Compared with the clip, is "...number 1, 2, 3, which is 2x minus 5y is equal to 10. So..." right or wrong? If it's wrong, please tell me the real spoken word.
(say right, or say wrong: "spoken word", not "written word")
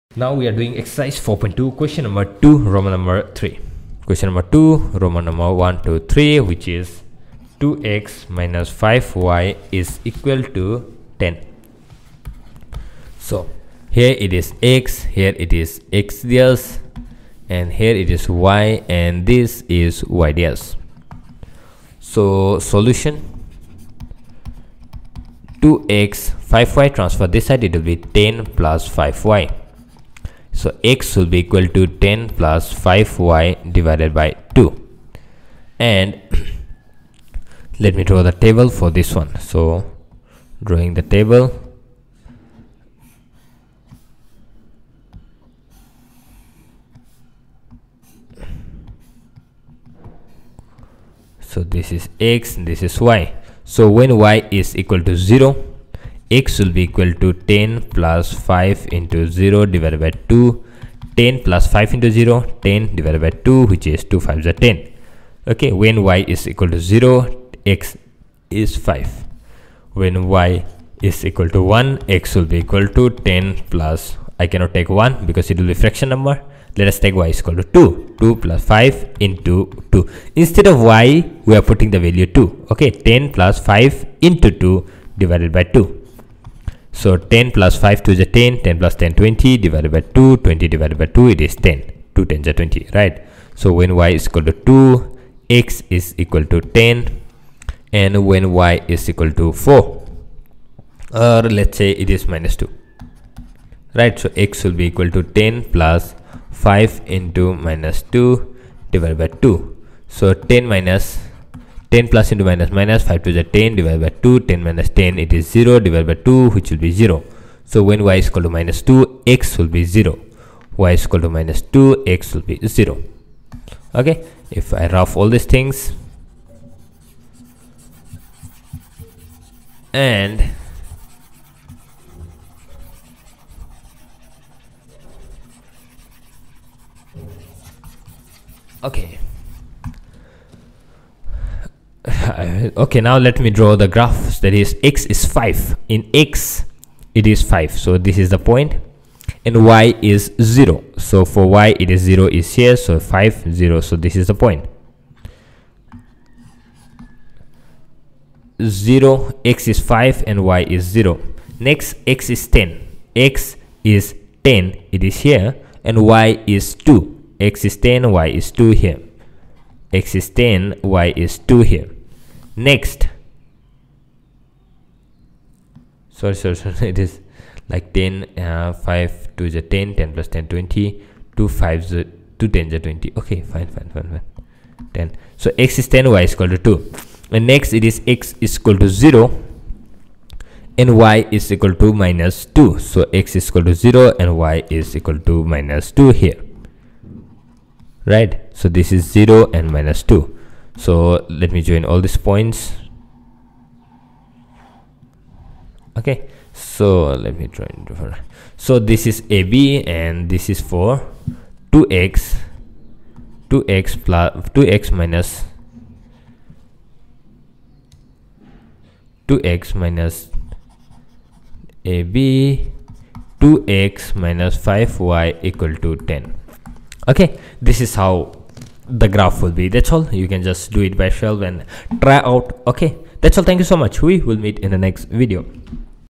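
right.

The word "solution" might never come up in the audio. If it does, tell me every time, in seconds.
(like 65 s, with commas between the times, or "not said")
22 s.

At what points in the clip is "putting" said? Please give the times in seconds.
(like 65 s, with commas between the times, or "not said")
81 s.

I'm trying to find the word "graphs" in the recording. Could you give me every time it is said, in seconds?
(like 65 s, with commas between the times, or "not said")
143 s, 229 s.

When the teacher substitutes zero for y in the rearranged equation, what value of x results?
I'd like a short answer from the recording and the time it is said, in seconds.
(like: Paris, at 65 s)
5, at 65 s.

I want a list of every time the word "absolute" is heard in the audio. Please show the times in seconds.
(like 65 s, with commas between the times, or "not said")
not said.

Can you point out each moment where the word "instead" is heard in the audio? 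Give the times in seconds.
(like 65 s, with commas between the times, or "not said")
80 s.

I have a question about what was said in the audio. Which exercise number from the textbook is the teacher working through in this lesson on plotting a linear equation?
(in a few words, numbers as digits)
4.2.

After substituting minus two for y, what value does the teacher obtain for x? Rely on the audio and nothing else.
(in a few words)
0.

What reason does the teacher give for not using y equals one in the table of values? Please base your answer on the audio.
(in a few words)
fraction number.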